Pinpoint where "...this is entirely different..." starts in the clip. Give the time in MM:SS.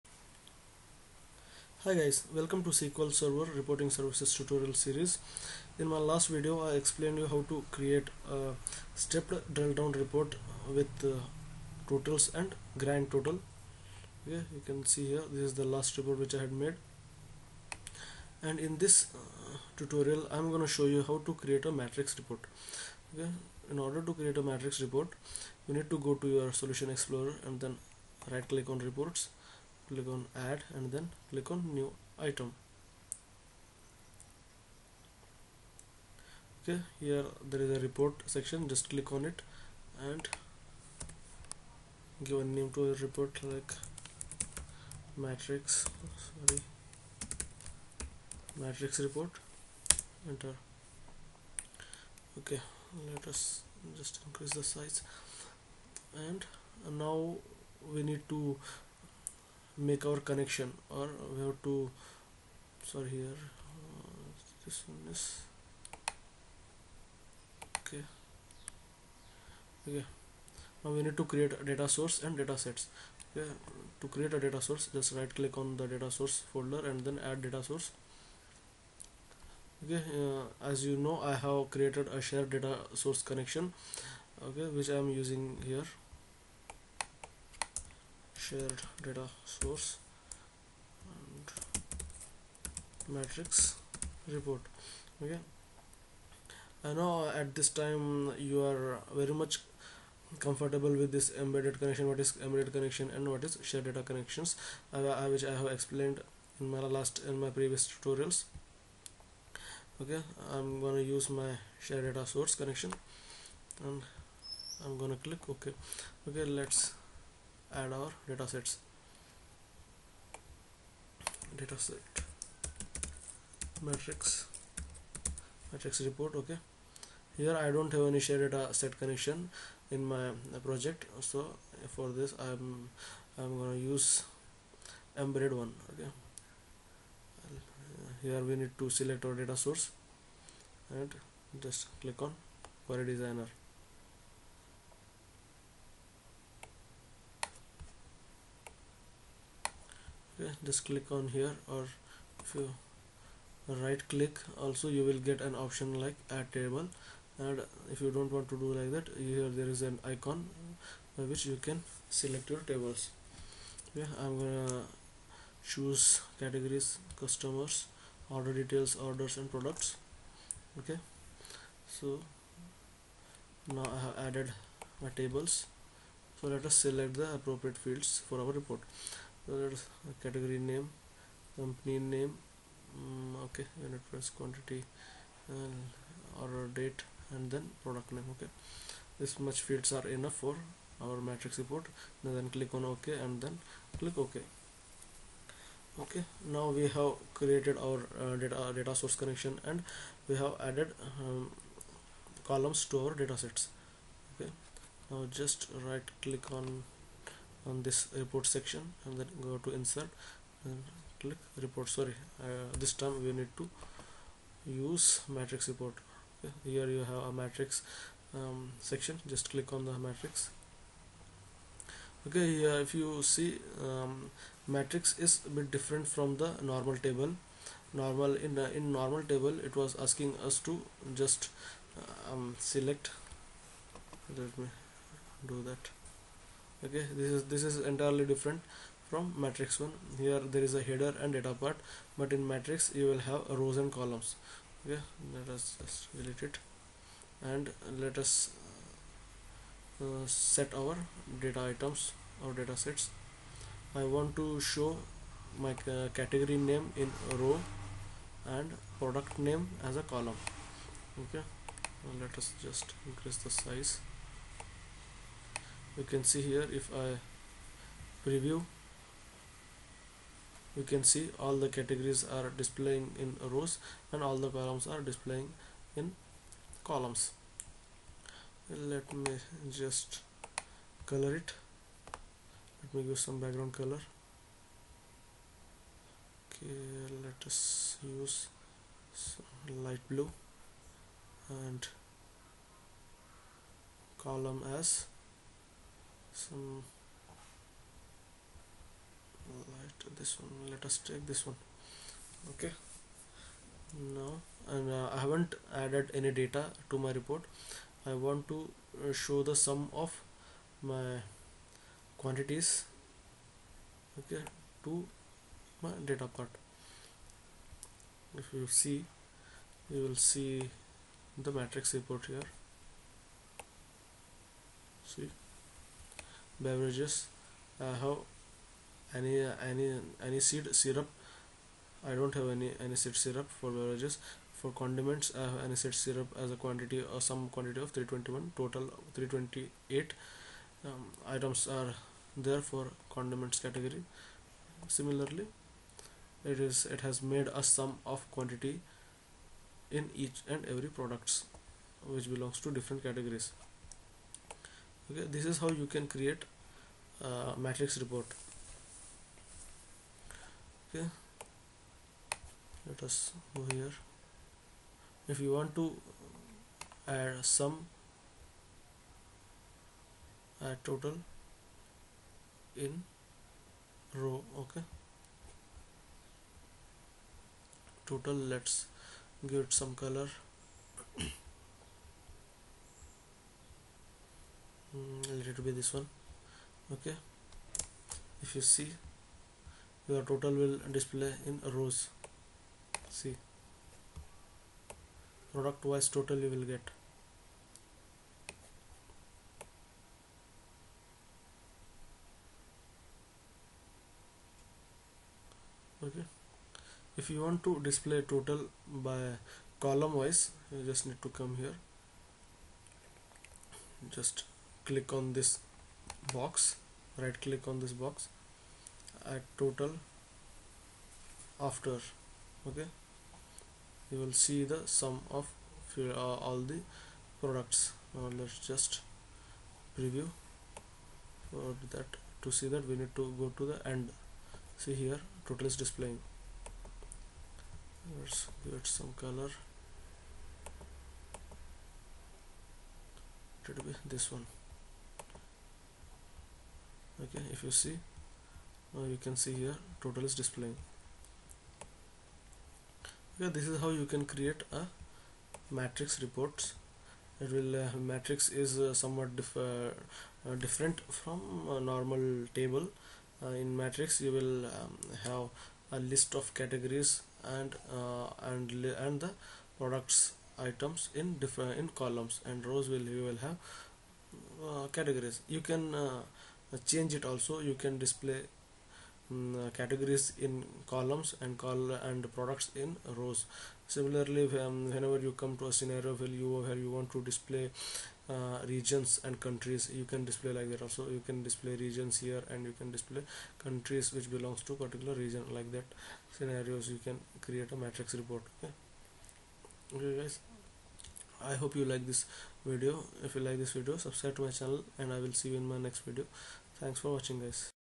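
03:57.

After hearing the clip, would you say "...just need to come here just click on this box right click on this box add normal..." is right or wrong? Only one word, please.
wrong.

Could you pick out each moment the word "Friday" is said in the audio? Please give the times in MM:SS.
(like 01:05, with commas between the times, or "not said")
not said.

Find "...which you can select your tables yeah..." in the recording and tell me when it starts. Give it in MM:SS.
02:41.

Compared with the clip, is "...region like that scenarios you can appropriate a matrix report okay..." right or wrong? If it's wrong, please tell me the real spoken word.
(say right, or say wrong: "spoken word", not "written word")
wrong: "create", not "appropriate".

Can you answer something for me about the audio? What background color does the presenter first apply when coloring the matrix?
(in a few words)
Light blue.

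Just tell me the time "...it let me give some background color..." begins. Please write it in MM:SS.
04:41.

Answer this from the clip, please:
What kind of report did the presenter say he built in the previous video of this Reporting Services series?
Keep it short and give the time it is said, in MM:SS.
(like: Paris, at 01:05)
Stepped drill down report, at 00:08.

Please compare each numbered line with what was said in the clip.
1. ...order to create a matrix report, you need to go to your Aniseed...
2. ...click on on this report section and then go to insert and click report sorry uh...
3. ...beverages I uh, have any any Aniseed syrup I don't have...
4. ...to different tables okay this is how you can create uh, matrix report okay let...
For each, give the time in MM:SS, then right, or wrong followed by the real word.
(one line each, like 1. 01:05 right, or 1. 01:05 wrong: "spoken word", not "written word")
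1. 00:23 wrong: "Solution", not "Aniseed"
2. 03:26 right
3. 05:26 right
4. 05:52 wrong: "categories", not "tables".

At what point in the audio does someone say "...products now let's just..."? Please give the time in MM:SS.
07:07.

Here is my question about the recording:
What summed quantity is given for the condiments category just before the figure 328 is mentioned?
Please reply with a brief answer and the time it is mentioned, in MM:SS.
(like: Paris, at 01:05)
321, at 05:37.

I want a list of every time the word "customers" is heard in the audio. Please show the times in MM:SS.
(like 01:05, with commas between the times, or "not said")
02:47.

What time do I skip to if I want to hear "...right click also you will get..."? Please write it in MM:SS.
02:33.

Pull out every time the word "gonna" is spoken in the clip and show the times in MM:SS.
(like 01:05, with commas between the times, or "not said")
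01:50, 01:54, 02:13, 02:44.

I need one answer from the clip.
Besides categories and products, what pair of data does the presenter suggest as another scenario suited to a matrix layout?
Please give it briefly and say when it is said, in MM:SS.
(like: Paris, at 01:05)
Regions and countries, at 08:08.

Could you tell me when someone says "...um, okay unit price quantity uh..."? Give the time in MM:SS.
03:02.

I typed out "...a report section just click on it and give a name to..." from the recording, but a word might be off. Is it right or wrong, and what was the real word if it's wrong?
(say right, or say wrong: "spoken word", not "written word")
right.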